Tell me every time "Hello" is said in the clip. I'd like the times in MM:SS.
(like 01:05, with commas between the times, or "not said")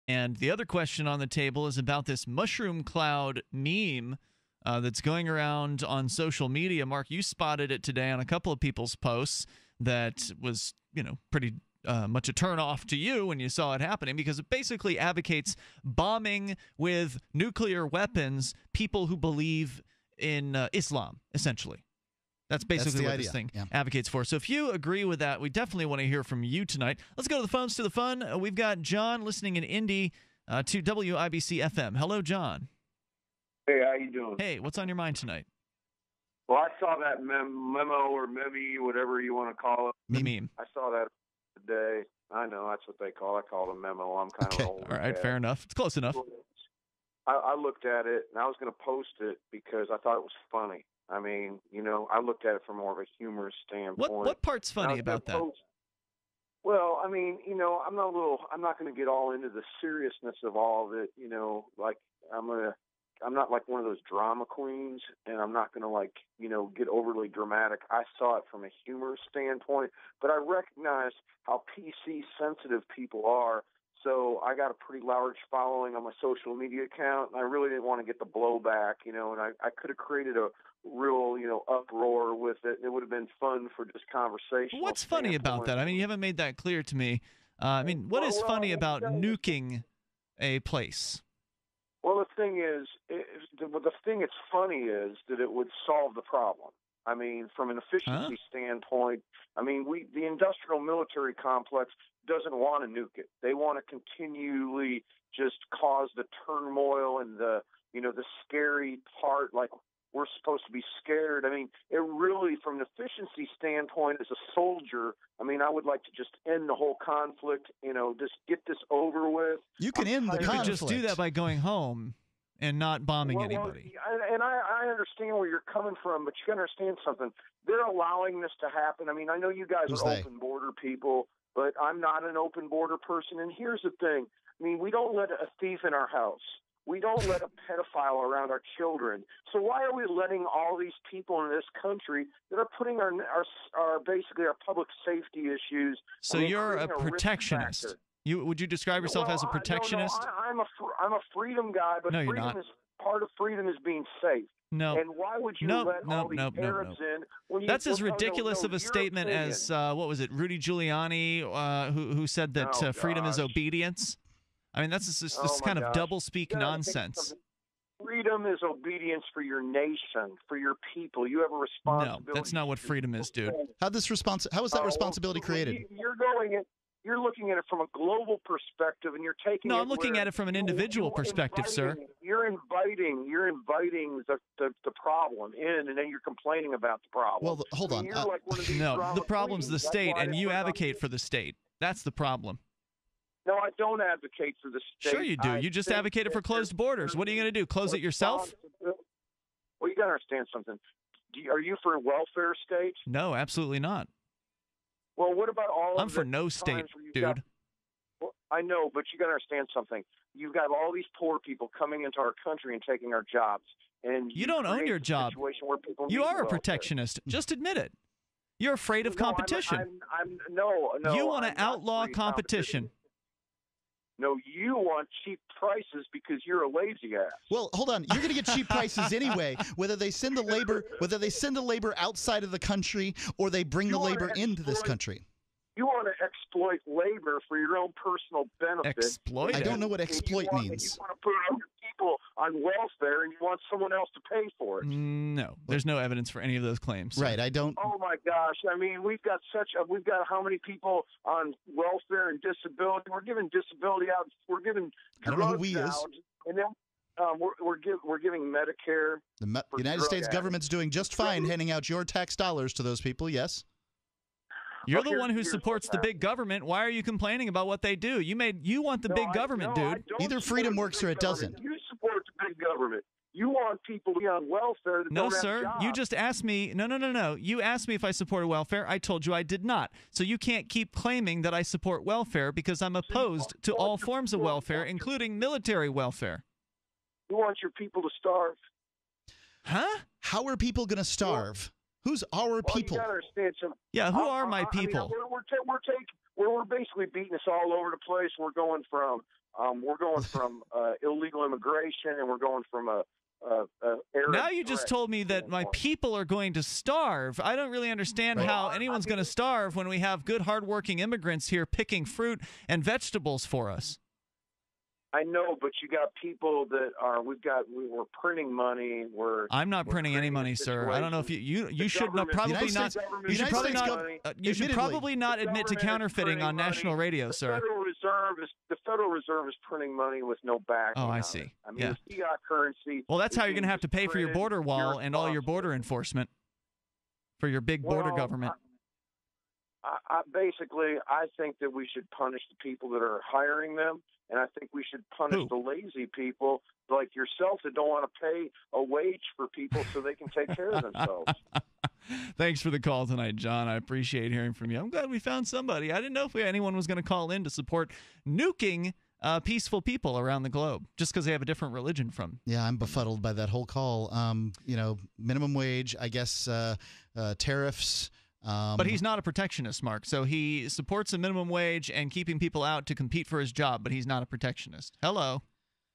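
00:31, 06:15.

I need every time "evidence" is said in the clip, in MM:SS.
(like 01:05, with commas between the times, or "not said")
04:05.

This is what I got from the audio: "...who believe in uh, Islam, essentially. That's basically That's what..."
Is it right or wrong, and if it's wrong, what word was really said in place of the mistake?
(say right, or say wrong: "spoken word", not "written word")
right.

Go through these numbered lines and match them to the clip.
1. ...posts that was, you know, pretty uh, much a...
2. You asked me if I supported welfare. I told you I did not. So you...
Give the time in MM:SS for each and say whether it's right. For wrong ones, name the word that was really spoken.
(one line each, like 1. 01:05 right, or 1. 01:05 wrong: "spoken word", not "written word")
1. 00:08 right
2. 04:37 right.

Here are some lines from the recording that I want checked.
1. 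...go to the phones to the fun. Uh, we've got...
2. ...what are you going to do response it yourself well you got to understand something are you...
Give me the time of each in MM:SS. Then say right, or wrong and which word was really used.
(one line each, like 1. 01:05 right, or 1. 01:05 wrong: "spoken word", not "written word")
1. 00:27 right
2. 03:17 wrong: "close", not "response".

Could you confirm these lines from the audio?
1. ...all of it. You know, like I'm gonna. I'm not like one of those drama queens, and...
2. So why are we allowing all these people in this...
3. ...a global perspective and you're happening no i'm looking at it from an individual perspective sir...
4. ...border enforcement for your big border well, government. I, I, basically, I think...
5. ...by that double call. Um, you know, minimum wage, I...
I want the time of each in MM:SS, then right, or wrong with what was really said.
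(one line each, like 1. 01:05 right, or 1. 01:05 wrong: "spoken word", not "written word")
1. 01:00 right
2. 02:19 wrong: "letting", not "allowing"
3. 02:57 wrong: "taking", not "happening"
4. 05:35 right
5. 06:03 wrong: "whole", not "double".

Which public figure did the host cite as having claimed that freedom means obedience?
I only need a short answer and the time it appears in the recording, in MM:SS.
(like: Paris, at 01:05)
Rudy Giuliani, at 02:40.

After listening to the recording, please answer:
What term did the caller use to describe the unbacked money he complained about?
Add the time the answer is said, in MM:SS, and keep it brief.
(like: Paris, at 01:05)
fiat currency, at 05:32.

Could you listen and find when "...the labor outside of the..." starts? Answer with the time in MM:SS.
03:51.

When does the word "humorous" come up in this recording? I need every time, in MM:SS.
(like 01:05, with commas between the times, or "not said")
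00:53, 01:08.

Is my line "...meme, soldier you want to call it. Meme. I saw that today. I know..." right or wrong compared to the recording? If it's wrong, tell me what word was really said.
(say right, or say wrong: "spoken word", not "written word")
wrong: "whatever", not "soldier".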